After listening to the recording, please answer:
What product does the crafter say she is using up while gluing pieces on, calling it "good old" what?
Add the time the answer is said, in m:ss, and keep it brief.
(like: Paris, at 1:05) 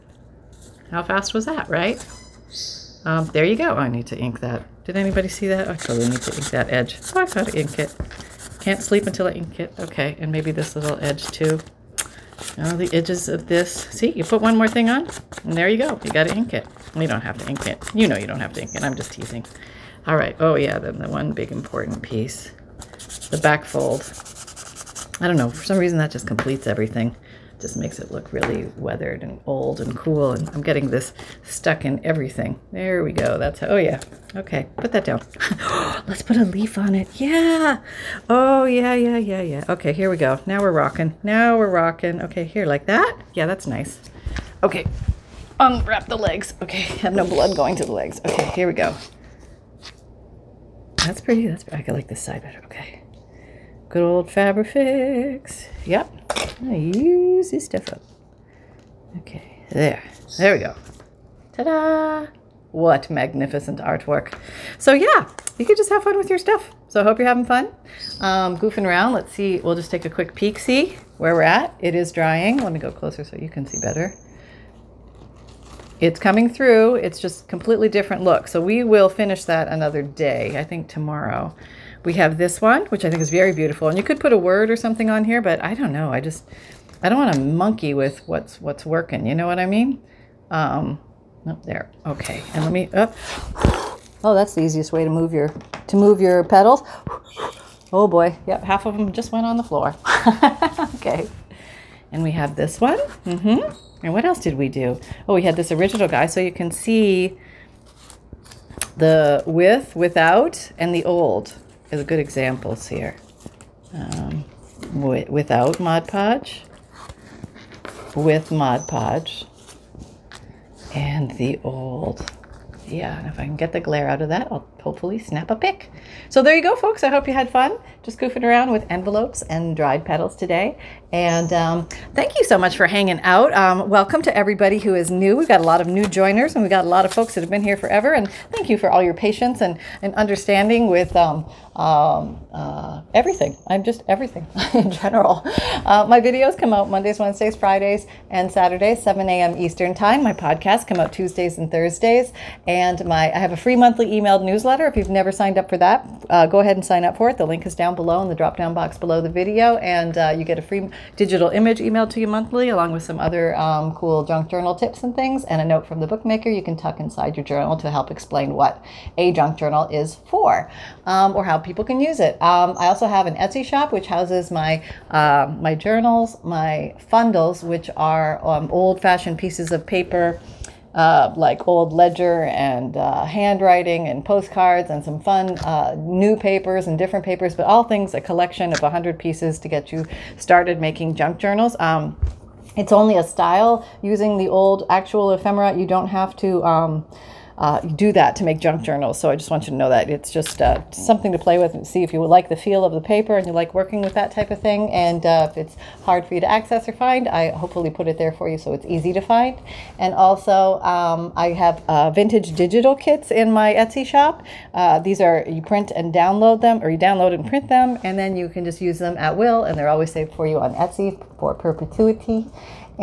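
Fabrifix, at 0:54.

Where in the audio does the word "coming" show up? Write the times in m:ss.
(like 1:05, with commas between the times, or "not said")
1:16.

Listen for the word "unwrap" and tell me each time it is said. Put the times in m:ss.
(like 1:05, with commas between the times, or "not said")
0:45.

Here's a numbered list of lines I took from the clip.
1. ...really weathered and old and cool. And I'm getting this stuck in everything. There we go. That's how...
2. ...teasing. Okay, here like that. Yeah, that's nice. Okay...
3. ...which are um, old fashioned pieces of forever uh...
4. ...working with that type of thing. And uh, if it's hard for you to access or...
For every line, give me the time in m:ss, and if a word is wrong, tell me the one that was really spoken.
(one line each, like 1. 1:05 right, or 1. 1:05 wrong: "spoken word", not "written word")
1. 0:28 right
2. 0:41 wrong: "rocking", not "teasing"
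3. 2:57 wrong: "paper", not "forever"
4. 3:23 right.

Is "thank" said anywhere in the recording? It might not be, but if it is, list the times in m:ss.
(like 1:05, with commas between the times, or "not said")
2:12, 2:18.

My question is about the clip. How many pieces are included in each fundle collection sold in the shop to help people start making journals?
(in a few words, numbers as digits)
100.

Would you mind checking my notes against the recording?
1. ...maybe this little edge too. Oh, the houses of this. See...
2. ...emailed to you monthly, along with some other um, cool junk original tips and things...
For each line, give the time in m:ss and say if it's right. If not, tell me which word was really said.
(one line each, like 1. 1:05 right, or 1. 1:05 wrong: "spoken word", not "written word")
1. 0:10 wrong: "edges", not "houses"
2. 2:41 wrong: "journal", not "original".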